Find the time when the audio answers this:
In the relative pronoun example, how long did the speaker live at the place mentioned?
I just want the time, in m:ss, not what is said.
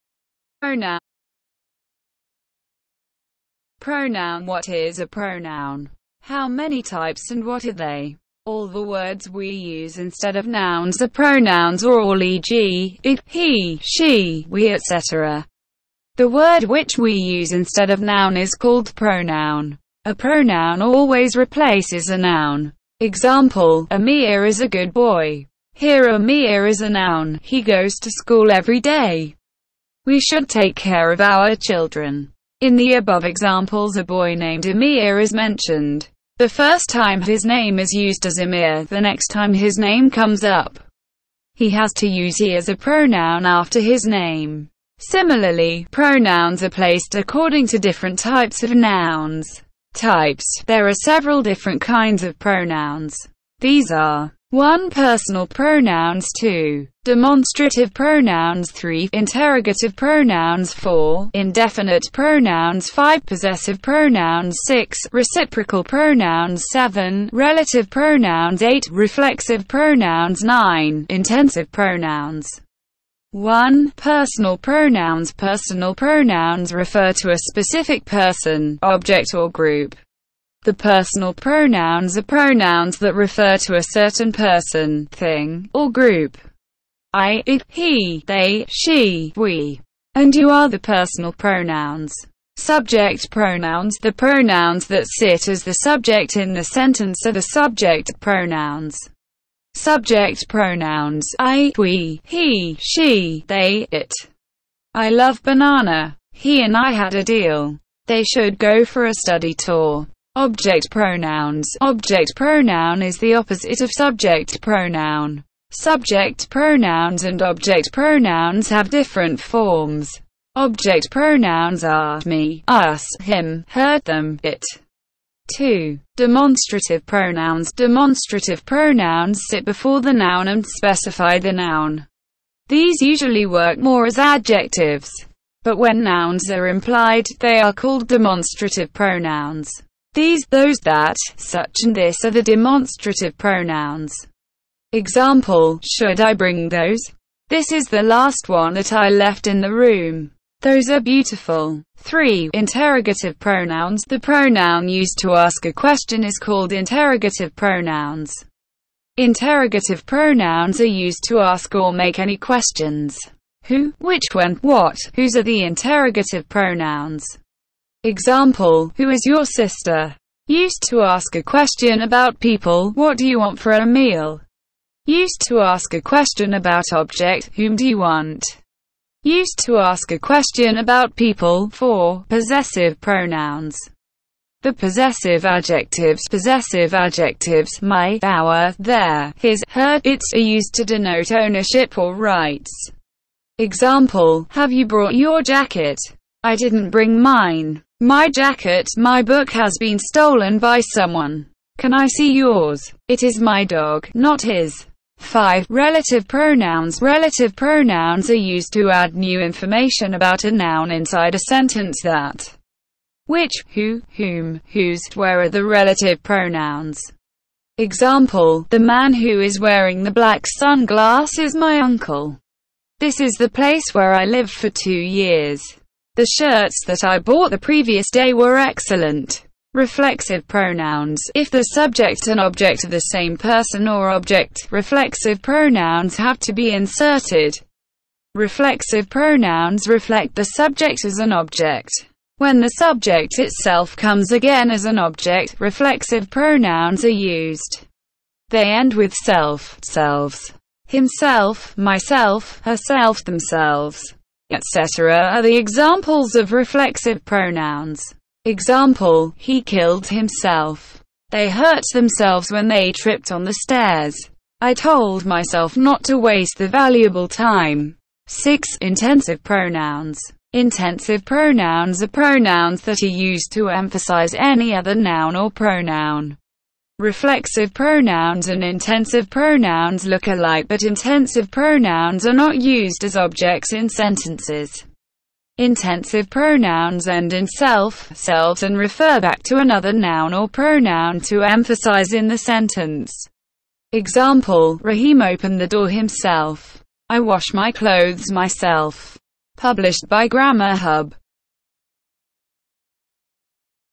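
3:44.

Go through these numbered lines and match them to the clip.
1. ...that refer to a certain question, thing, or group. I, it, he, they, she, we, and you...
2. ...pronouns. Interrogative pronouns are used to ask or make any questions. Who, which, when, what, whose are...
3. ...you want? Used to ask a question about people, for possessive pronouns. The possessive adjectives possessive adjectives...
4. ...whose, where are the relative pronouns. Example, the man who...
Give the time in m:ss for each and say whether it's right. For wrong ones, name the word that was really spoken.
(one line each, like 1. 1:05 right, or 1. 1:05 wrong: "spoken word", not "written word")
1. 1:22 wrong: "person", not "question"
2. 2:37 right
3. 2:57 right
4. 3:34 right.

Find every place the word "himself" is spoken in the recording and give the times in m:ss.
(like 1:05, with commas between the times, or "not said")
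4:10, 4:20, 4:55.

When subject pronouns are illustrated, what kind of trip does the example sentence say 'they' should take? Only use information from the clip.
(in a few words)
study tour.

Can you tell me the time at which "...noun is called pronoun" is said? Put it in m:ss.
0:17.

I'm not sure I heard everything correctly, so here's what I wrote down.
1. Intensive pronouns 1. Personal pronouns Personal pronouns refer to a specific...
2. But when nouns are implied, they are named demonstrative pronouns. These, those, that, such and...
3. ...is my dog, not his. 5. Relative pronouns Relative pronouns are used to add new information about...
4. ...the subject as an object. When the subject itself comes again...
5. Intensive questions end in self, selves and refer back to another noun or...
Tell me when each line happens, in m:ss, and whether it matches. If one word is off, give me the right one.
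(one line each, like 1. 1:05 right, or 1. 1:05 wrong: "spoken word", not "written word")
1. 1:11 right
2. 2:15 wrong: "called", not "named"
3. 3:23 right
4. 4:00 right
5. 4:45 wrong: "pronouns", not "questions".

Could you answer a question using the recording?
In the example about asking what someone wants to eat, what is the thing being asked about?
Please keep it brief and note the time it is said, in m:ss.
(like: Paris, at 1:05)
a meal, at 2:53.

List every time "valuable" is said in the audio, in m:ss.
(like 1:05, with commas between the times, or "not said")
4:26.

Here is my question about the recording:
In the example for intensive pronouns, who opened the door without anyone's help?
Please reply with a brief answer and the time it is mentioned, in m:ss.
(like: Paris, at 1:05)
Rahim, at 4:54.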